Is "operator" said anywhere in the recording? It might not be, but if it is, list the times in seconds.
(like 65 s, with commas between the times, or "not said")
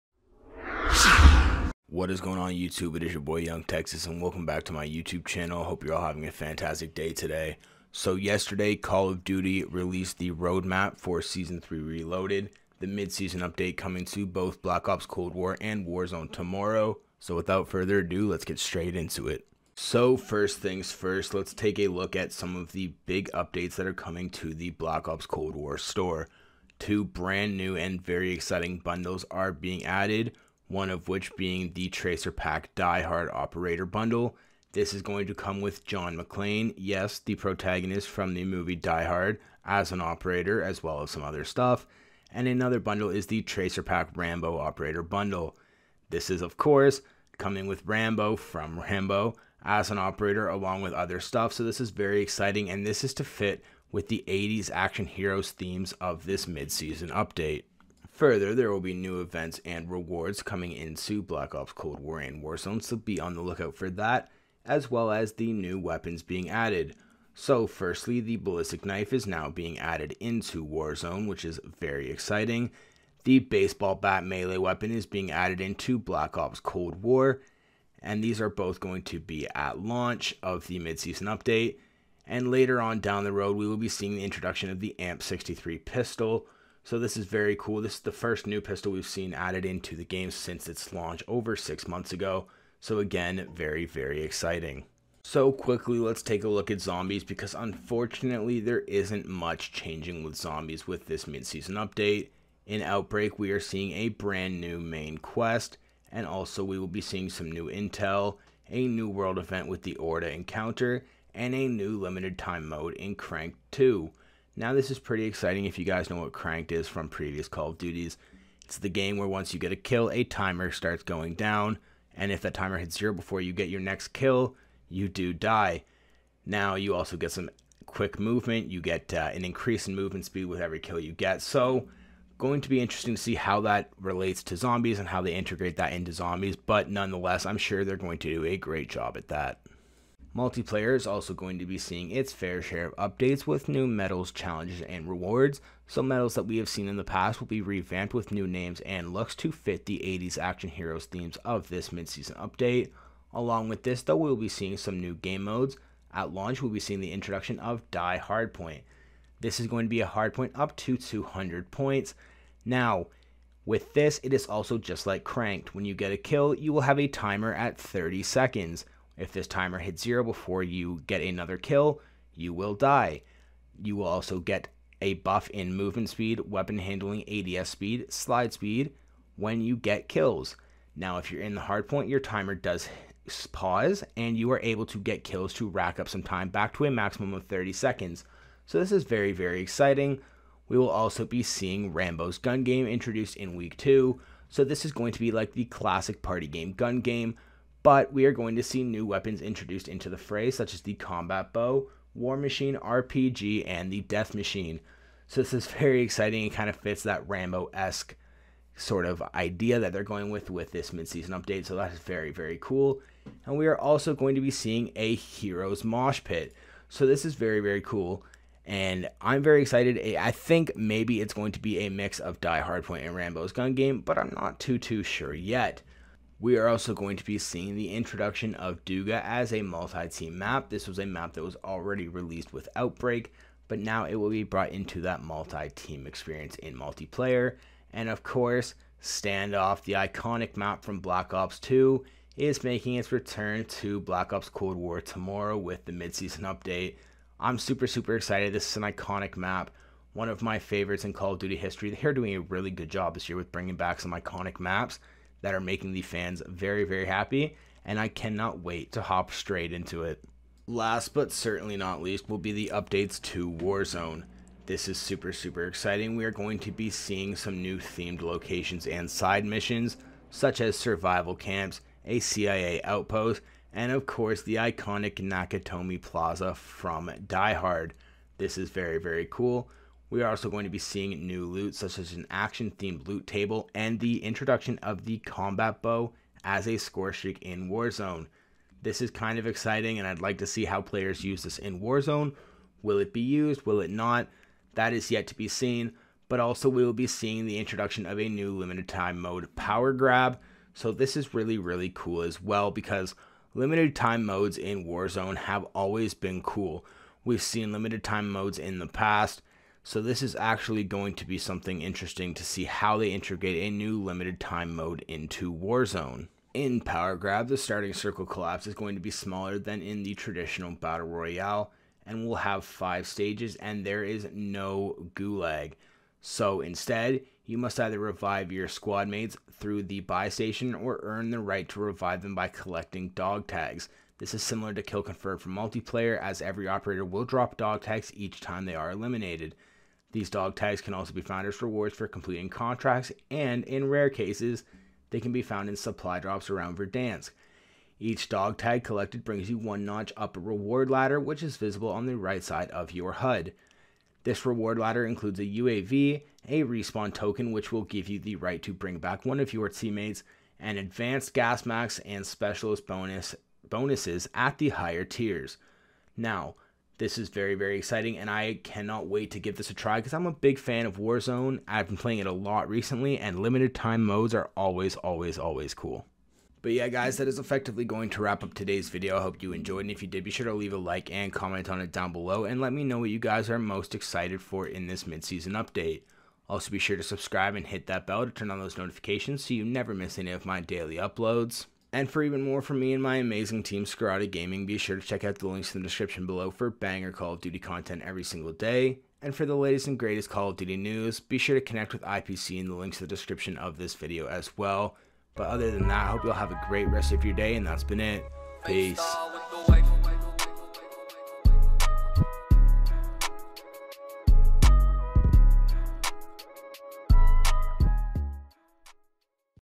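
33 s, 39 s, 44 s, 49 s, 336 s.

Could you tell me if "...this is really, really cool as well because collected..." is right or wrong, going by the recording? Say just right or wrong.
wrong.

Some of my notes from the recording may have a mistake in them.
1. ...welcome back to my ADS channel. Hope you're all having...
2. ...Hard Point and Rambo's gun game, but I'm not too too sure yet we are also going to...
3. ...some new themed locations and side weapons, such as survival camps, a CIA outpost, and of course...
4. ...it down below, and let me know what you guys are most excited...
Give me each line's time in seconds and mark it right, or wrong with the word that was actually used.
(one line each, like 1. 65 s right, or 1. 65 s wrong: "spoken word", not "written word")
1. 4 s wrong: "YouTube", not "ADS"
2. 222 s right
3. 267 s wrong: "missions", not "weapons"
4. 381 s right.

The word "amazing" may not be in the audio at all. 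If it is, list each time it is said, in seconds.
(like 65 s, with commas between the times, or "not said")
393 s.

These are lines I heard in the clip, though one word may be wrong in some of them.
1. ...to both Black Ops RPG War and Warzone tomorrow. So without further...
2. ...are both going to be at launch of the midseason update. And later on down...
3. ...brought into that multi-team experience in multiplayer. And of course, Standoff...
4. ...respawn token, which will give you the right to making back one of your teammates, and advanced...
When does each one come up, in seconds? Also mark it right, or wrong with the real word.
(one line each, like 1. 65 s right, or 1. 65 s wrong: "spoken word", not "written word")
1. 14 s wrong: "Cold", not "RPG"
2. 78 s right
3. 234 s right
4. 356 s wrong: "bring", not "making".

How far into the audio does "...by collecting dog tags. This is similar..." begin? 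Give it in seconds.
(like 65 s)
332 s.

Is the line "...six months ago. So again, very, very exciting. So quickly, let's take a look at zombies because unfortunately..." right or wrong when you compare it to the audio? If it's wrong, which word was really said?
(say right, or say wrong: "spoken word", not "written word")
right.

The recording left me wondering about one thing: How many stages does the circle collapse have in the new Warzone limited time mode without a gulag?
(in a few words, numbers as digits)
5.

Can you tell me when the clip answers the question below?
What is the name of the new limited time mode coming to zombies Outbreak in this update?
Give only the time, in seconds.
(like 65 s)
113 s.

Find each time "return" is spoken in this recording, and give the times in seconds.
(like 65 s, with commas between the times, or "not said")
243 s.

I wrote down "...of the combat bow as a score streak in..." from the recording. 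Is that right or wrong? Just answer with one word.
right.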